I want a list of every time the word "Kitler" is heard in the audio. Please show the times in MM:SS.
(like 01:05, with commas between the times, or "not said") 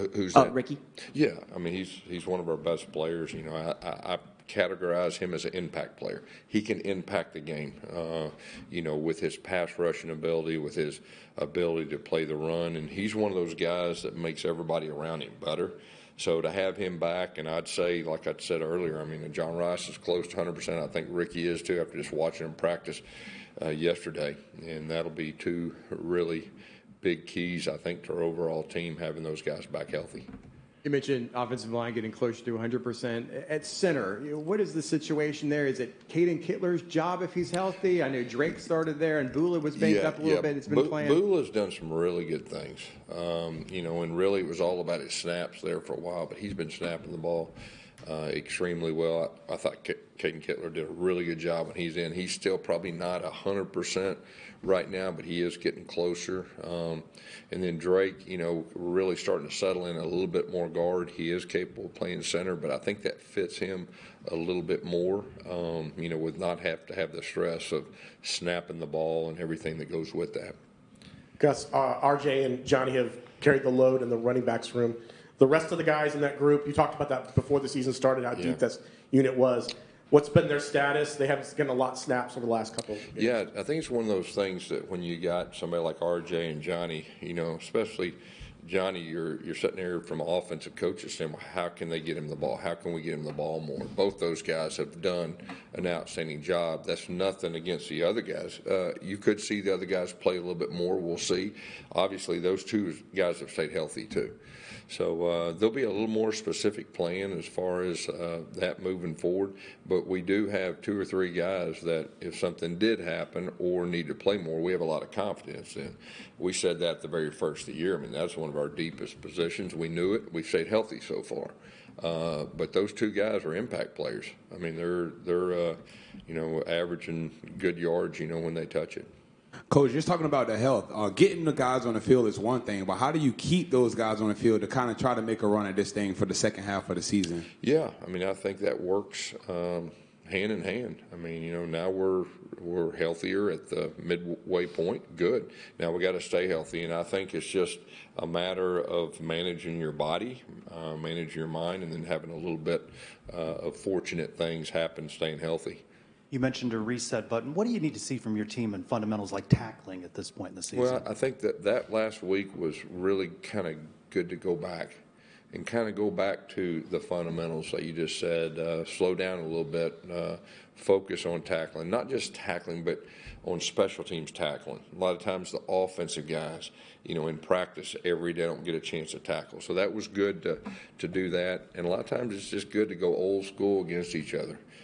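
00:36, 00:50.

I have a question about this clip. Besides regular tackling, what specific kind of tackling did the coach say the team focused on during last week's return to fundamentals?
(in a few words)
special teams tackling.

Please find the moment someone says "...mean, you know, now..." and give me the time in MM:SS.
02:21.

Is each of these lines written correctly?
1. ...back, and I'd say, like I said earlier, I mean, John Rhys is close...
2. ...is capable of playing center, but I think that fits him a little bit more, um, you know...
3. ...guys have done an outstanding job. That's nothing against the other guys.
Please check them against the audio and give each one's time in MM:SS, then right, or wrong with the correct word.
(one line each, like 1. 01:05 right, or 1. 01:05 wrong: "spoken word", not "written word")
1. 00:16 right
2. 01:01 right
3. 01:34 right.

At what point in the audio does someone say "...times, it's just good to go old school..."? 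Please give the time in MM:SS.
03:02.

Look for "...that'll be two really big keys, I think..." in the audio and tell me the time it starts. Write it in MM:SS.
00:24.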